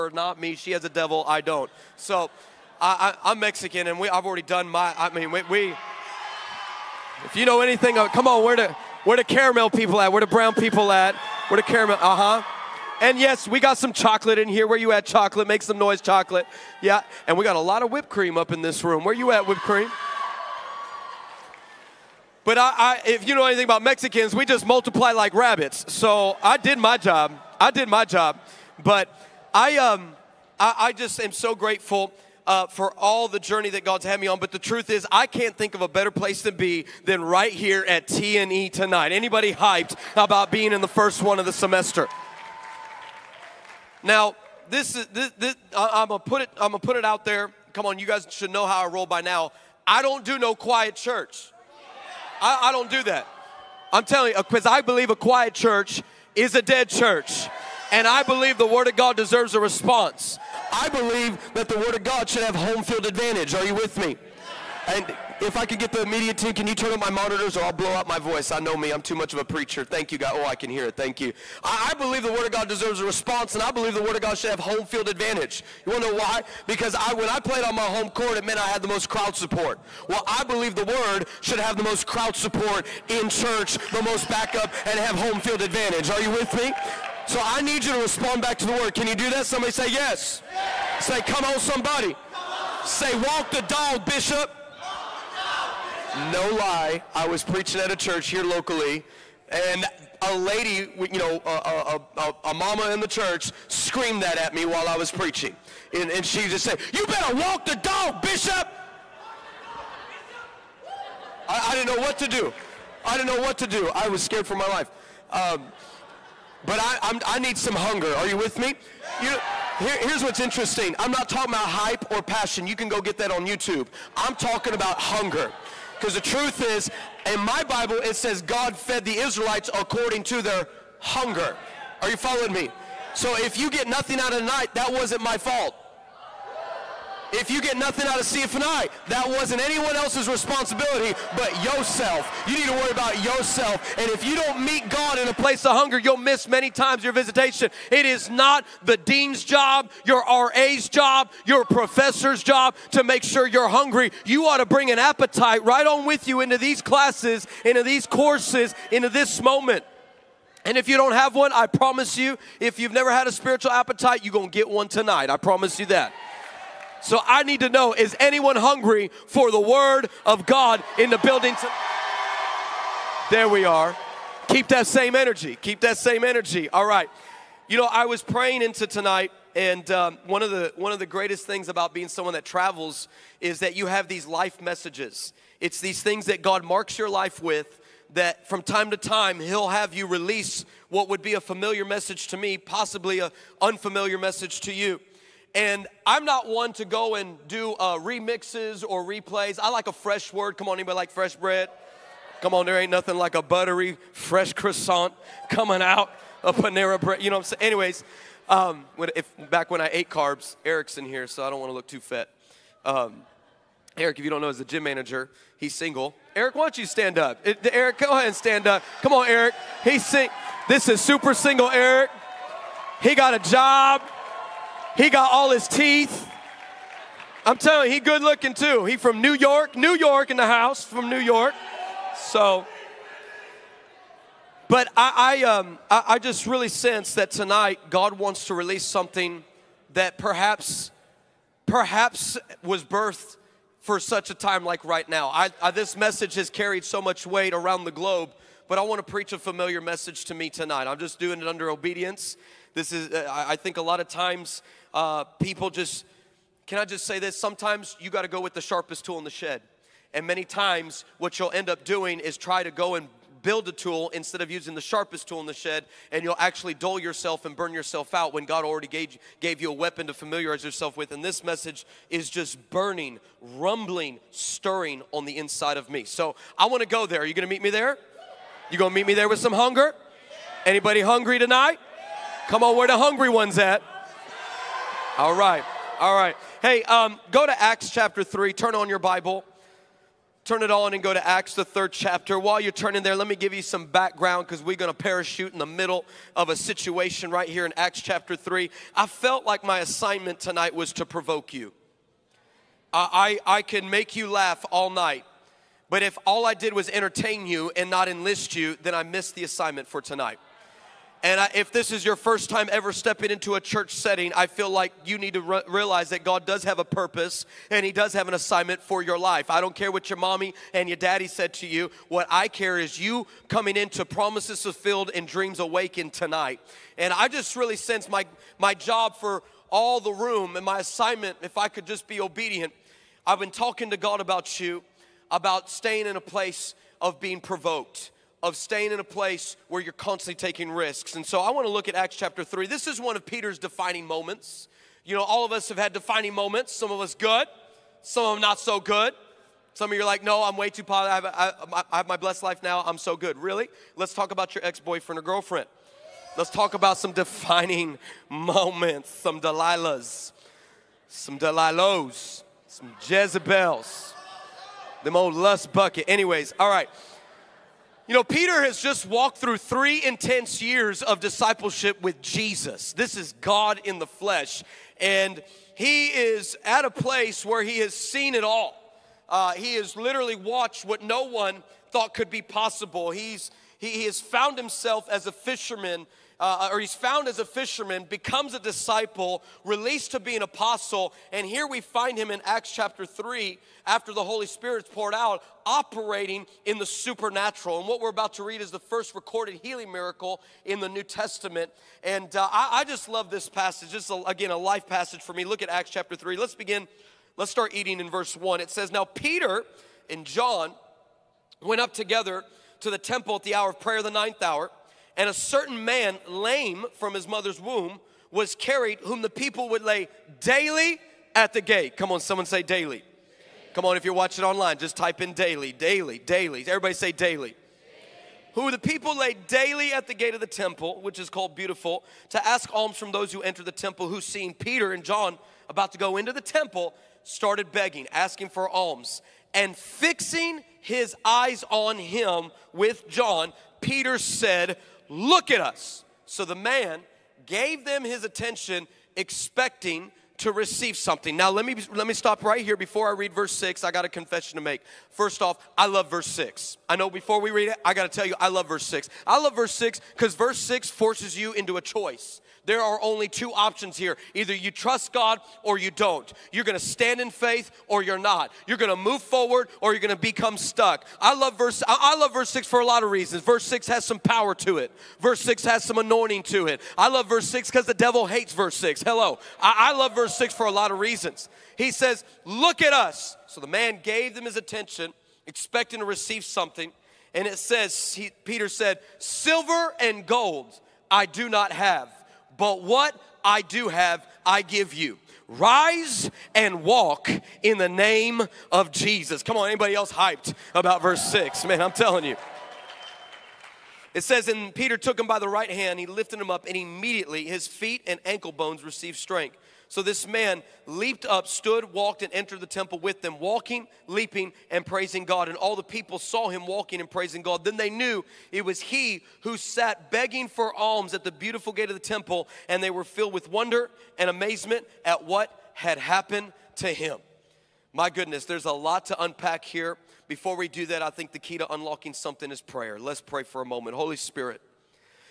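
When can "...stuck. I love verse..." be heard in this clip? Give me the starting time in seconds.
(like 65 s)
470 s.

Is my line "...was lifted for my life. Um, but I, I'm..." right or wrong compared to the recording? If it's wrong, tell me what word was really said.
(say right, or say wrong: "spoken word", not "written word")
wrong: "scared", not "lifted".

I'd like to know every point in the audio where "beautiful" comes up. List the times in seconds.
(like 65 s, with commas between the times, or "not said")
431 s, 521 s.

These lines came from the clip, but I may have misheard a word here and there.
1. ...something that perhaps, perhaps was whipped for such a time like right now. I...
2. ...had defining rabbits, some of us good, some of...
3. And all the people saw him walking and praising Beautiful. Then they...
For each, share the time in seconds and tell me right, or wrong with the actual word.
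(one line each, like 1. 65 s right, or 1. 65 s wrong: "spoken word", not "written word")
1. 238 s wrong: "birthed", not "whipped"
2. 345 s wrong: "moments", not "rabbits"
3. 515 s wrong: "God", not "Beautiful".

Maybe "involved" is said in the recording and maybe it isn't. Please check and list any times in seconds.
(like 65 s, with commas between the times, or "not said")
not said.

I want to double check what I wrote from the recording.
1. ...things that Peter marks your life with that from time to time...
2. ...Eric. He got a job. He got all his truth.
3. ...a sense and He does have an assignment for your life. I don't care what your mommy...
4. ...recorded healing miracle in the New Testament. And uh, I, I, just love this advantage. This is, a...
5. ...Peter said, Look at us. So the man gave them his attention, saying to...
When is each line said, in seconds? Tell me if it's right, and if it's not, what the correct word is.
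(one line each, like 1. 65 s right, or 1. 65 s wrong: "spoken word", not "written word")
1. 186 s wrong: "God", not "Peter"
2. 221 s wrong: "teeth", not "truth"
3. 316 s wrong: "purpose", not "sense"
4. 399 s wrong: "passage", not "advantage"
5. 443 s wrong: "expecting", not "saying".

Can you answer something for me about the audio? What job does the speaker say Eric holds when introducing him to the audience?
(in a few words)
gym manager.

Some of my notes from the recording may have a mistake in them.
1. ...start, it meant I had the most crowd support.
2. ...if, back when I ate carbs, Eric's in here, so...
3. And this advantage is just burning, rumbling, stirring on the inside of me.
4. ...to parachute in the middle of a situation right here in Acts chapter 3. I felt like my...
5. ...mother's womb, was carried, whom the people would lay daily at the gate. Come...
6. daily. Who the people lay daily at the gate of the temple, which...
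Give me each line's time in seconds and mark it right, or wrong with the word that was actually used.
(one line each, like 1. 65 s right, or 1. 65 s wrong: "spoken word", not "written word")
1. 78 s wrong: "court", not "start"
2. 209 s right
3. 271 s wrong: "message", not "advantage"
4. 294 s right
5. 417 s right
6. 427 s right.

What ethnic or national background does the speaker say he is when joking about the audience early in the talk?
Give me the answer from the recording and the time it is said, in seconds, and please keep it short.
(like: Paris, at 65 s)
Mexican, at 3 s.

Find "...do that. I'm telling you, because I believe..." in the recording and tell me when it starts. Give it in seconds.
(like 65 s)
52 s.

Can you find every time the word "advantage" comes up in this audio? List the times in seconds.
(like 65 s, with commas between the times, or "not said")
63 s, 75 s, 85 s.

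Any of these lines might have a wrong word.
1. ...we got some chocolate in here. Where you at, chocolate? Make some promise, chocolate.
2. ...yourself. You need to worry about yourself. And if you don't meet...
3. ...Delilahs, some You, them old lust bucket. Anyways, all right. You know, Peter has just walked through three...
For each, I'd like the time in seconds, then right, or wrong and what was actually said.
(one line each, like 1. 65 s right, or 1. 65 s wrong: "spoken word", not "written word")
1. 13 s wrong: "noise", not "promise"
2. 141 s right
3. 361 s wrong: "Jezebels", not "You".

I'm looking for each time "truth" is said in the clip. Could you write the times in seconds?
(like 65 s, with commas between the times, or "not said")
34 s, 126 s.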